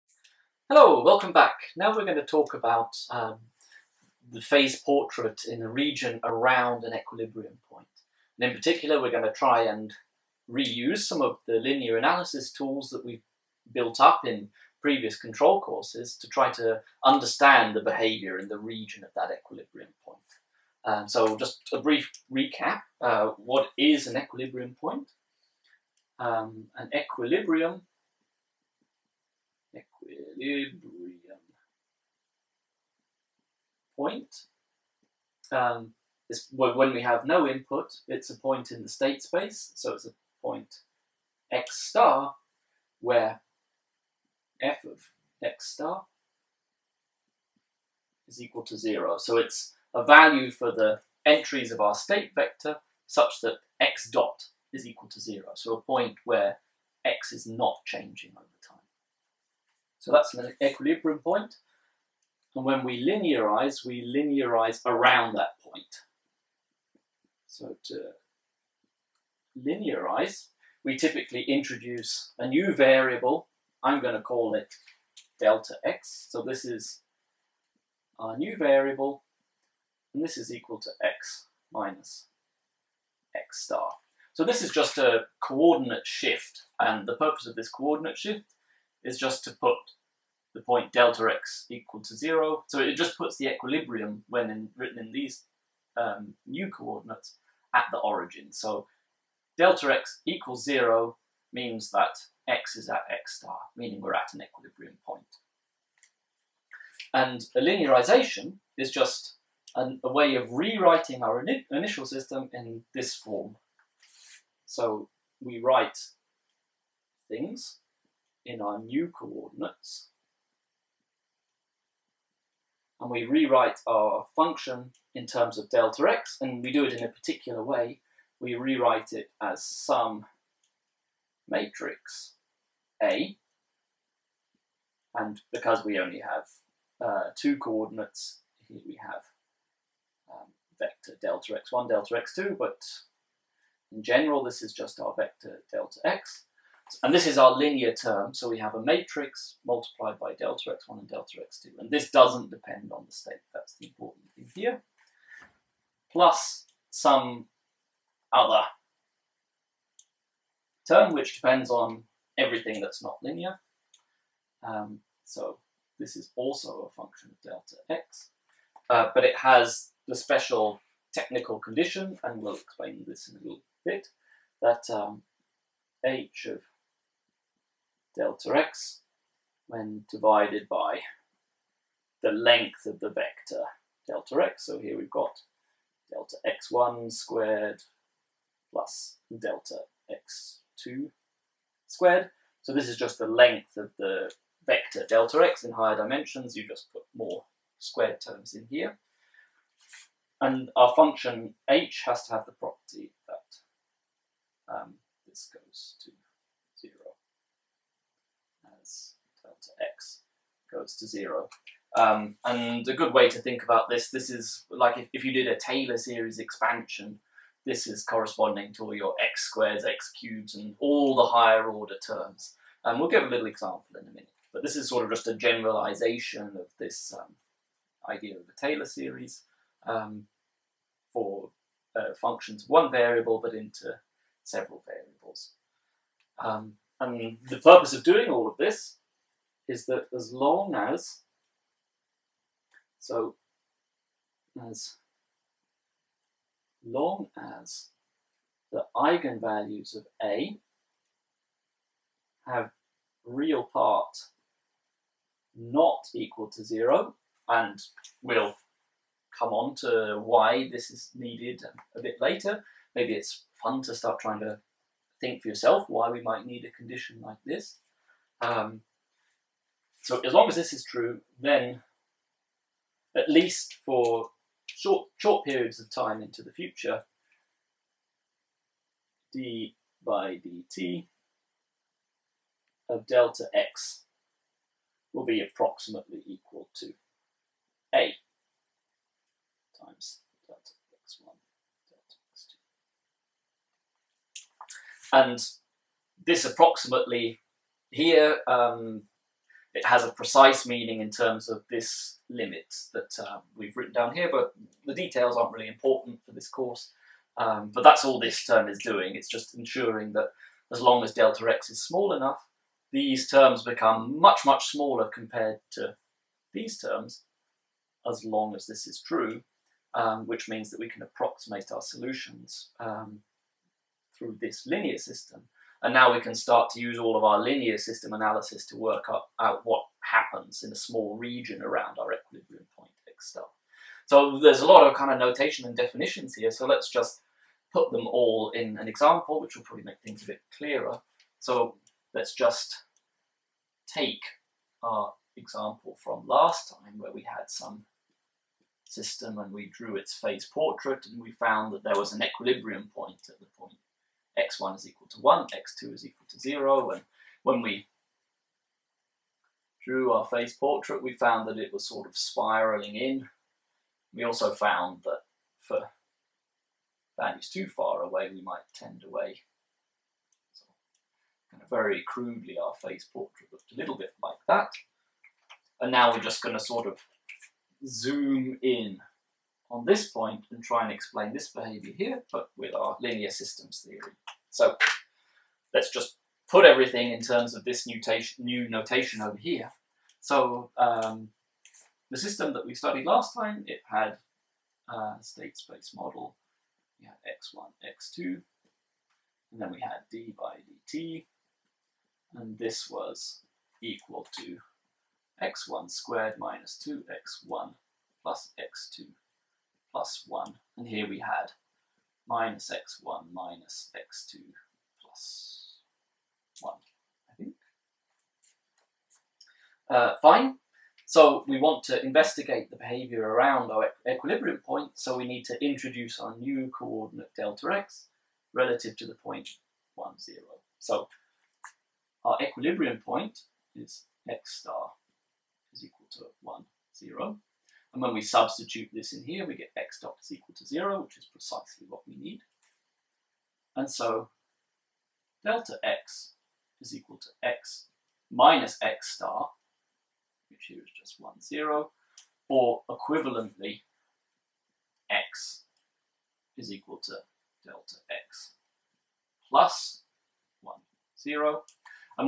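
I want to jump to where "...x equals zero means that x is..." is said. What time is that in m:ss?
1:39.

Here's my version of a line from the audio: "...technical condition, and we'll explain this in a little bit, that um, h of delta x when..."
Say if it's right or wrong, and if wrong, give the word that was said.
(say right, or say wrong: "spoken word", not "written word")
right.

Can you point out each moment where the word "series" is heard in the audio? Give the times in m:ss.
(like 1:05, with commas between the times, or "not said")
3:35, 3:48.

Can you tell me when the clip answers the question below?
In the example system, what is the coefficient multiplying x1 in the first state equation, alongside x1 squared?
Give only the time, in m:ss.
6:46.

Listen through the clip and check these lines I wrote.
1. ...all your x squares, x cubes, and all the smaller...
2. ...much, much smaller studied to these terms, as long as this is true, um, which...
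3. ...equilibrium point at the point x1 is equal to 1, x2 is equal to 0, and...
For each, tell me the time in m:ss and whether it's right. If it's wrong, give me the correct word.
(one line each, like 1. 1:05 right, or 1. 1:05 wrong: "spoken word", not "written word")
1. 3:38 wrong: "higher", not "smaller"
2. 5:14 wrong: "compared", not "studied"
3. 5:52 right.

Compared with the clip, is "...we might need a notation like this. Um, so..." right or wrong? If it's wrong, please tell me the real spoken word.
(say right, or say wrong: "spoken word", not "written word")
wrong: "condition", not "notation".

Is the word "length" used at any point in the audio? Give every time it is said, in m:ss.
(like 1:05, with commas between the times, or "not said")
3:02, 3:13.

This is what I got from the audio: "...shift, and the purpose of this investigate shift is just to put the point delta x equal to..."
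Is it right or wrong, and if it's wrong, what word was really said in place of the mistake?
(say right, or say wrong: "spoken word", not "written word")
wrong: "coordinate", not "investigate".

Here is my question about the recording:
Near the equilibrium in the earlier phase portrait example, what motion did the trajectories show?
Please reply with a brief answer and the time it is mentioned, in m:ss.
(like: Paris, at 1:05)
spiraling in, at 6:02.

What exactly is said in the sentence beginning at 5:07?
Um, but that's all this term is doing.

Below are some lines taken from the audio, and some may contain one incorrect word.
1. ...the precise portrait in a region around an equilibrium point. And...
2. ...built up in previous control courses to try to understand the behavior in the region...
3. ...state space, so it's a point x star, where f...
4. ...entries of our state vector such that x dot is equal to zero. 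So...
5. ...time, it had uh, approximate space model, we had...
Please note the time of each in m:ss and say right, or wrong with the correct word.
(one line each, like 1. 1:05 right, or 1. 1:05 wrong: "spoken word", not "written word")
1. 0:04 wrong: "phase", not "precise"
2. 0:13 right
3. 0:38 right
4. 0:51 right
5. 6:33 wrong: "state", not "approximate".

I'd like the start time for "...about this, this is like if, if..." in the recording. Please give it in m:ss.
3:33.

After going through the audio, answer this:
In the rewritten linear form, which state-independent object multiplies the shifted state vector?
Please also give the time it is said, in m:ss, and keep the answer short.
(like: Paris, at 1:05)
matrix A, at 2:11.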